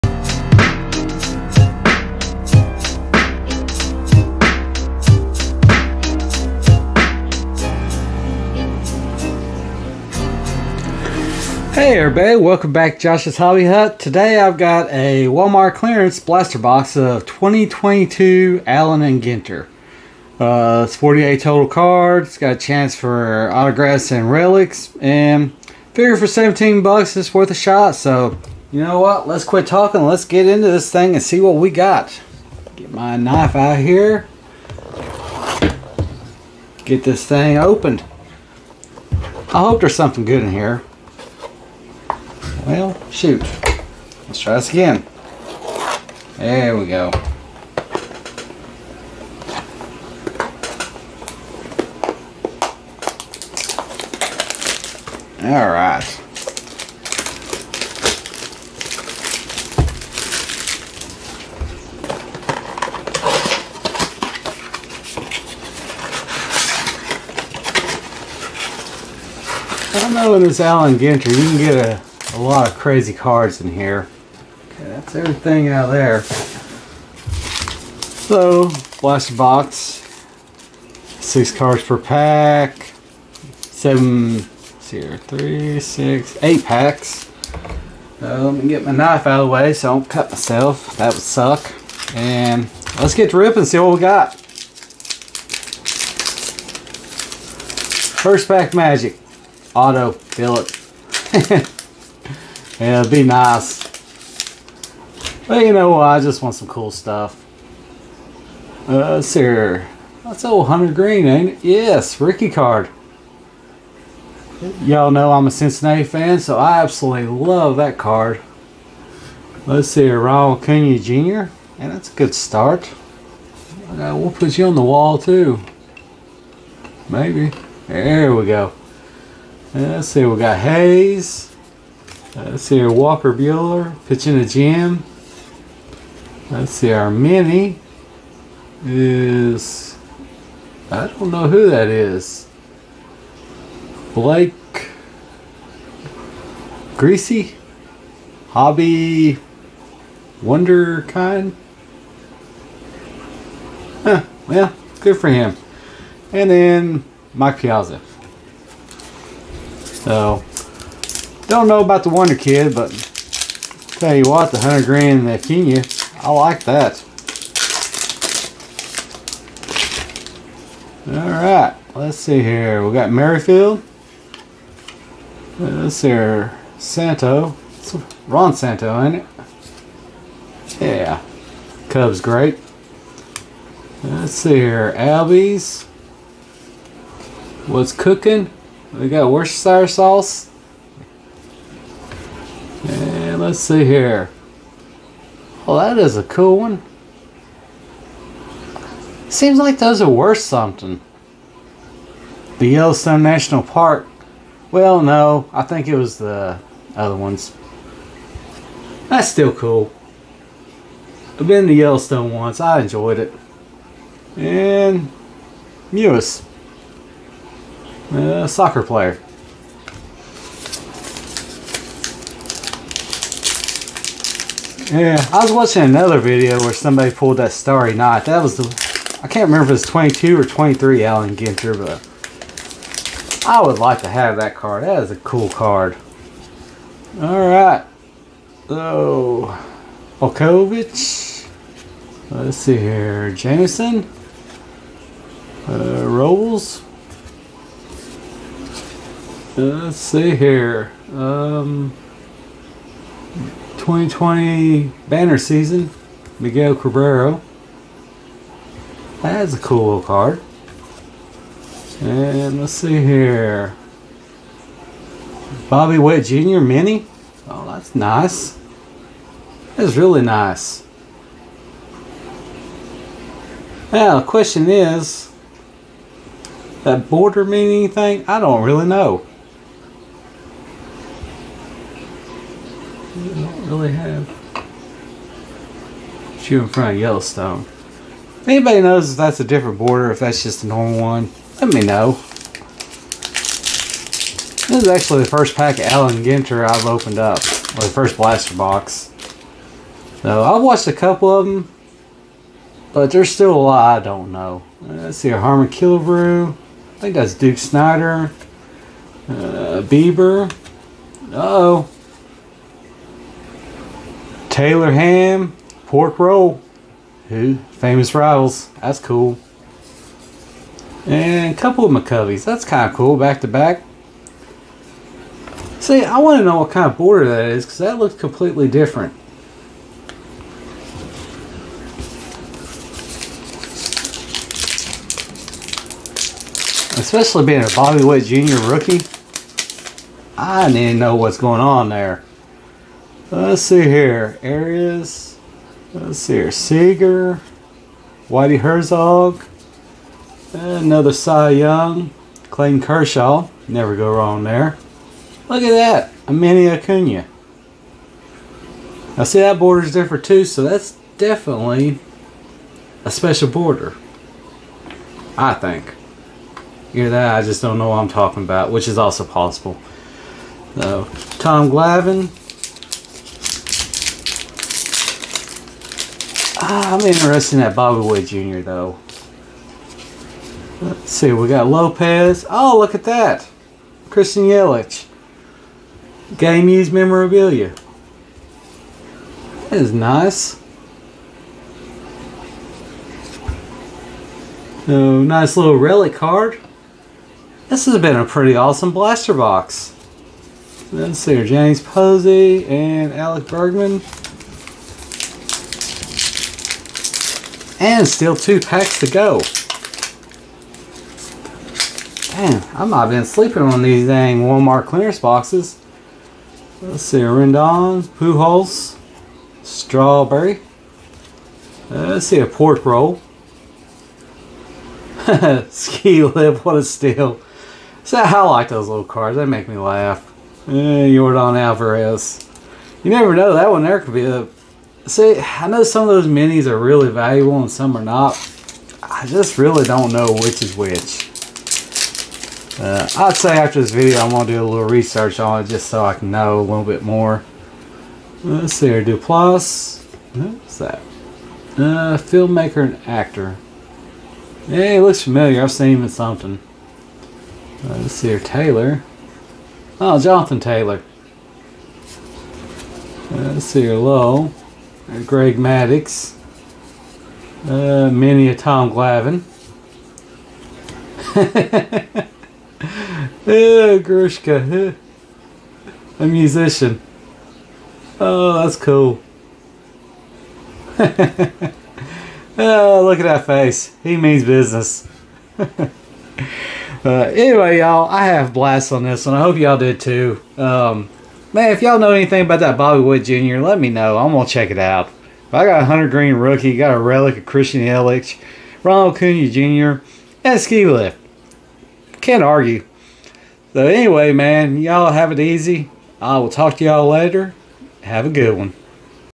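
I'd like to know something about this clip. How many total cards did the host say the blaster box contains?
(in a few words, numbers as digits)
48.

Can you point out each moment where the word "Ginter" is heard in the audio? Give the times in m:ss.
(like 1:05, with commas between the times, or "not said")
0:19, 1:10, 3:51, 4:56.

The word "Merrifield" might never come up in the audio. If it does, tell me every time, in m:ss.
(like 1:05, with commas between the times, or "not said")
2:53.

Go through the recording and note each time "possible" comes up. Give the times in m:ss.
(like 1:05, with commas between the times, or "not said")
6:09.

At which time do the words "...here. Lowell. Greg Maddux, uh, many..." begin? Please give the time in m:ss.
7:43.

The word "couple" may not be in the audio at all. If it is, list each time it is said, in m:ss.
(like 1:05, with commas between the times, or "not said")
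5:00, 5:21.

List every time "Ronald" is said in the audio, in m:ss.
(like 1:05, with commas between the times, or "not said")
2:00, 8:18.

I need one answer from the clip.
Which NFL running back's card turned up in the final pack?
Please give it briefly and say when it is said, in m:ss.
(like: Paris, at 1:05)
Jonathan Taylor, at 7:40.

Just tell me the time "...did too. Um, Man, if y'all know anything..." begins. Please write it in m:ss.
8:09.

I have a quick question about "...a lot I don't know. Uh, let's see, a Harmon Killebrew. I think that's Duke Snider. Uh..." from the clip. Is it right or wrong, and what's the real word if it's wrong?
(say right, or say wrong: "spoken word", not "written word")
right.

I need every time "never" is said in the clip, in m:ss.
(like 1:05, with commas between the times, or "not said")
5:53, 7:13.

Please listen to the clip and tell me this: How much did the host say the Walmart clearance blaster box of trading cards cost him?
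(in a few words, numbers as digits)
$17.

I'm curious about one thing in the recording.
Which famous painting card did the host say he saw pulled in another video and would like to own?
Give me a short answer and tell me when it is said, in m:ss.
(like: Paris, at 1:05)
Starry Night, at 3:47.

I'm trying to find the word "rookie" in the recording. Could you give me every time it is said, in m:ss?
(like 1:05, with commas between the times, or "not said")
1:52, 5:38, 8:16.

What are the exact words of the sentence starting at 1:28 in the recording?
let me get my knife out of the way so I don't cut myself.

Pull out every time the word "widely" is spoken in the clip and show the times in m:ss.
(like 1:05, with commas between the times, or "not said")
not said.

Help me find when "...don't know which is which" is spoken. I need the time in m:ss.
7:19.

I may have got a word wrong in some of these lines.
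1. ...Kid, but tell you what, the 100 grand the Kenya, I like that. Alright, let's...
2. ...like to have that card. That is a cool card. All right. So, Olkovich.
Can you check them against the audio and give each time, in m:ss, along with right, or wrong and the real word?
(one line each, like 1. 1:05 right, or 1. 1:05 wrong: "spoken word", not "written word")
1. 2:42 right
2. 3:53 right.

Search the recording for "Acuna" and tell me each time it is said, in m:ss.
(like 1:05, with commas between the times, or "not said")
2:00, 5:56, 8:19.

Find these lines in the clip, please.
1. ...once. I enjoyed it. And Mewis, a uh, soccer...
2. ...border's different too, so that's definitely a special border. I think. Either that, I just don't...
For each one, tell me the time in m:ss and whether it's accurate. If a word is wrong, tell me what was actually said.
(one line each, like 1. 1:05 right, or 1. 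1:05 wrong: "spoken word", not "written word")
1. 3:32 right
2. 5:59 right.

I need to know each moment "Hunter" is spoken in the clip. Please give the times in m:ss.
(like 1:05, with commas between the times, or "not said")
1:50, 8:15.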